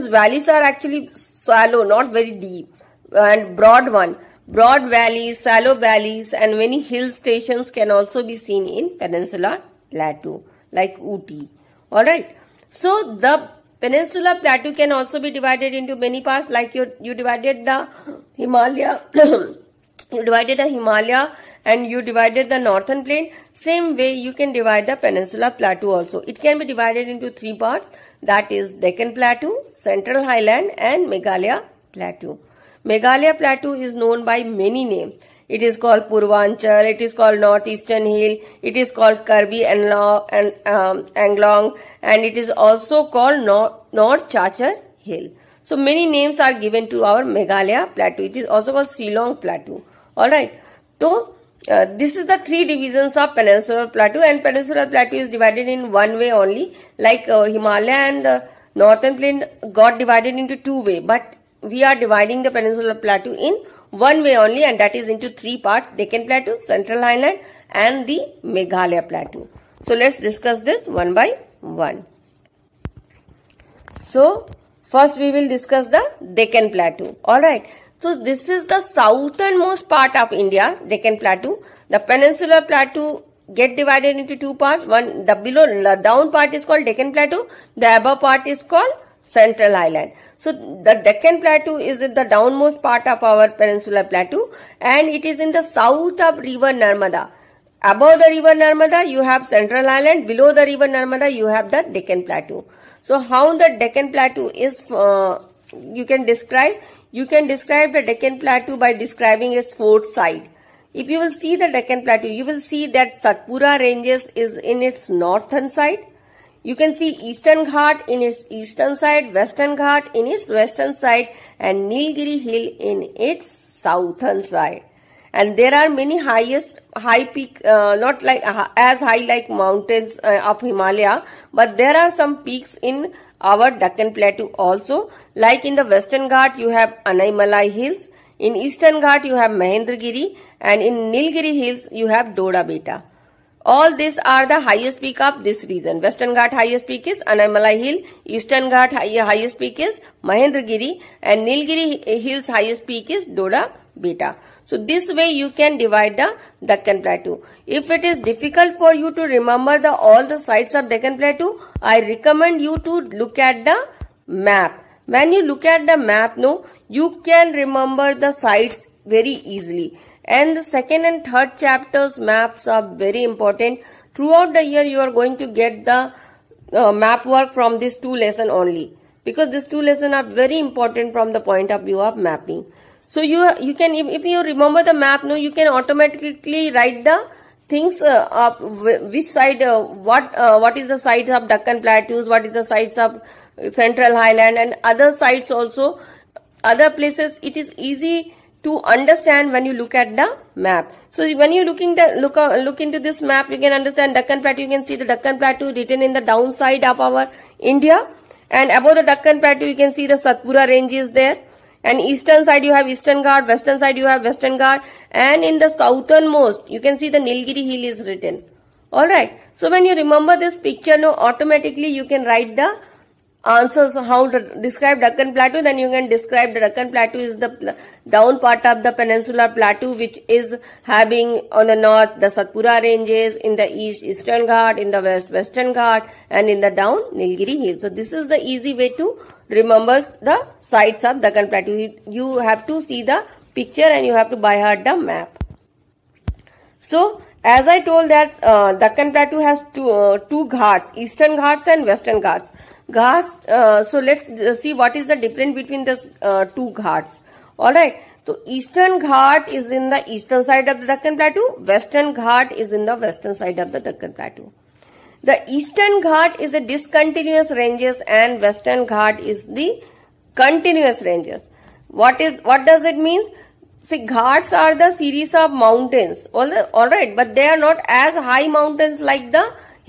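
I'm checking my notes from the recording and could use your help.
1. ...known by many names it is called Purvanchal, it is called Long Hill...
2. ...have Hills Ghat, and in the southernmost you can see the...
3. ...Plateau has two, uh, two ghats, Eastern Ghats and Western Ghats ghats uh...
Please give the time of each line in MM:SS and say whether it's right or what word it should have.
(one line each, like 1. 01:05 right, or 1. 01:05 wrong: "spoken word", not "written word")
1. 00:33 wrong: "Northeastern", not "Long"
2. 03:34 wrong: "Western", not "Hills"
3. 04:09 right.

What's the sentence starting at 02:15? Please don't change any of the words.
Like in the Western Ghat, you have Anaimalai Hills.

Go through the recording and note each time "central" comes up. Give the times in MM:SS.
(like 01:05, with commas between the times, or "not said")
00:29, 01:06, 01:29, 01:39, 03:13.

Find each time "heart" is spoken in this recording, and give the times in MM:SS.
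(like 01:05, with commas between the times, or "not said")
04:04.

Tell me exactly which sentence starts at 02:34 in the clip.
So this way you can divide the Deccan Plateau.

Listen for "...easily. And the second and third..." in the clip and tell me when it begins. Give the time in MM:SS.
02:49.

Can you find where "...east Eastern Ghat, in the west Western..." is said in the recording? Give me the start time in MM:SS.
03:53.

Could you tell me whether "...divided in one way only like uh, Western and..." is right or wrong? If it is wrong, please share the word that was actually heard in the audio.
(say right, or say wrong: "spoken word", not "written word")
wrong: "Himalaya", not "Western".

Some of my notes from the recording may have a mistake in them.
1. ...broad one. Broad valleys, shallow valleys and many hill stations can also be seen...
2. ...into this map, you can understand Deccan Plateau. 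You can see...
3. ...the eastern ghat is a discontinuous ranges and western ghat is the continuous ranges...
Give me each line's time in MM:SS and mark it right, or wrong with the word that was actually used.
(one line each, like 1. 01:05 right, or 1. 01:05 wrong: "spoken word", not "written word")
1. 00:03 right
2. 03:22 right
3. 04:25 right.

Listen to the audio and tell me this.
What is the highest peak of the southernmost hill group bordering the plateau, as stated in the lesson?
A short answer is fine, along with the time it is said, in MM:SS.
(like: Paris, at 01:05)
Doddabetta, at 02:22.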